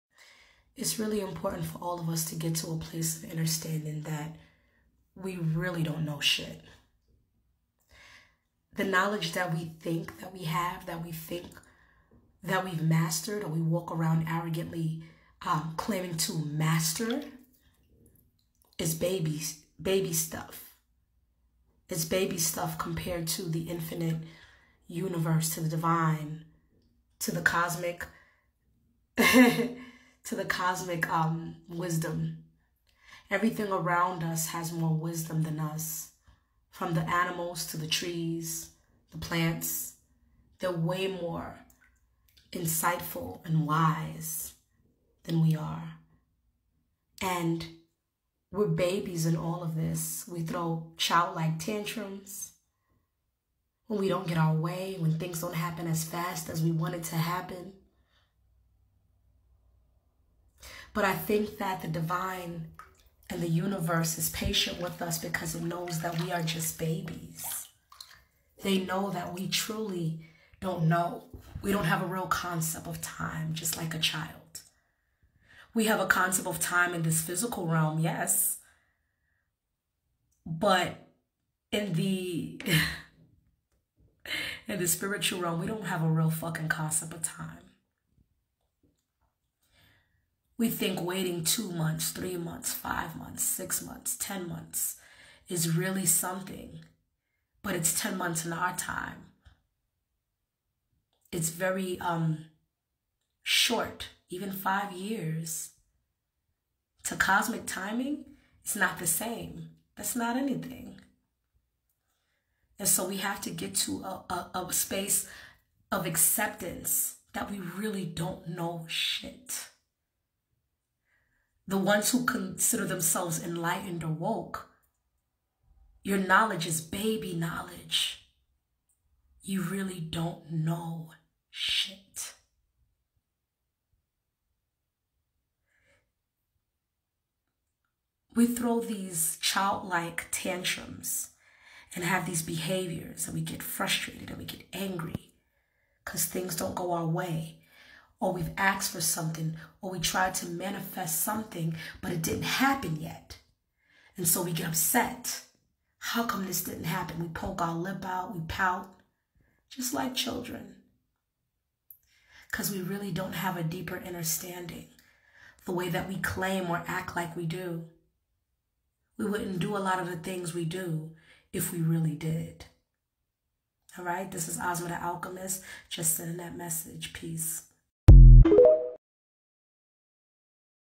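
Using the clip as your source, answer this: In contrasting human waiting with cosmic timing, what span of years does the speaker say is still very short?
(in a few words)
5 years.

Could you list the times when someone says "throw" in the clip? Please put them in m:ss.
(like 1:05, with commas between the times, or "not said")
0:50, 2:18.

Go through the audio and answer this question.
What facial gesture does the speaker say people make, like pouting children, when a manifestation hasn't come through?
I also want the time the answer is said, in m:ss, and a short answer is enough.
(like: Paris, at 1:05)
poke our lip out, at 2:37.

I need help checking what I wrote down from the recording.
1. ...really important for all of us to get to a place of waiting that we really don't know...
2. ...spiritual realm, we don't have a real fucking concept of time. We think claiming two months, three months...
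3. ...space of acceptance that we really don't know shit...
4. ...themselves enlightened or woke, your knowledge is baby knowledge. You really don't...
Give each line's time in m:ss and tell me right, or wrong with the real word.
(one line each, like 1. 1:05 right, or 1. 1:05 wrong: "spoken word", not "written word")
1. 0:00 wrong: "understanding", not "waiting"
2. 1:24 wrong: "waiting", not "claiming"
3. 1:54 right
4. 2:02 right.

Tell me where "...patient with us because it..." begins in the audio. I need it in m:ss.
1:04.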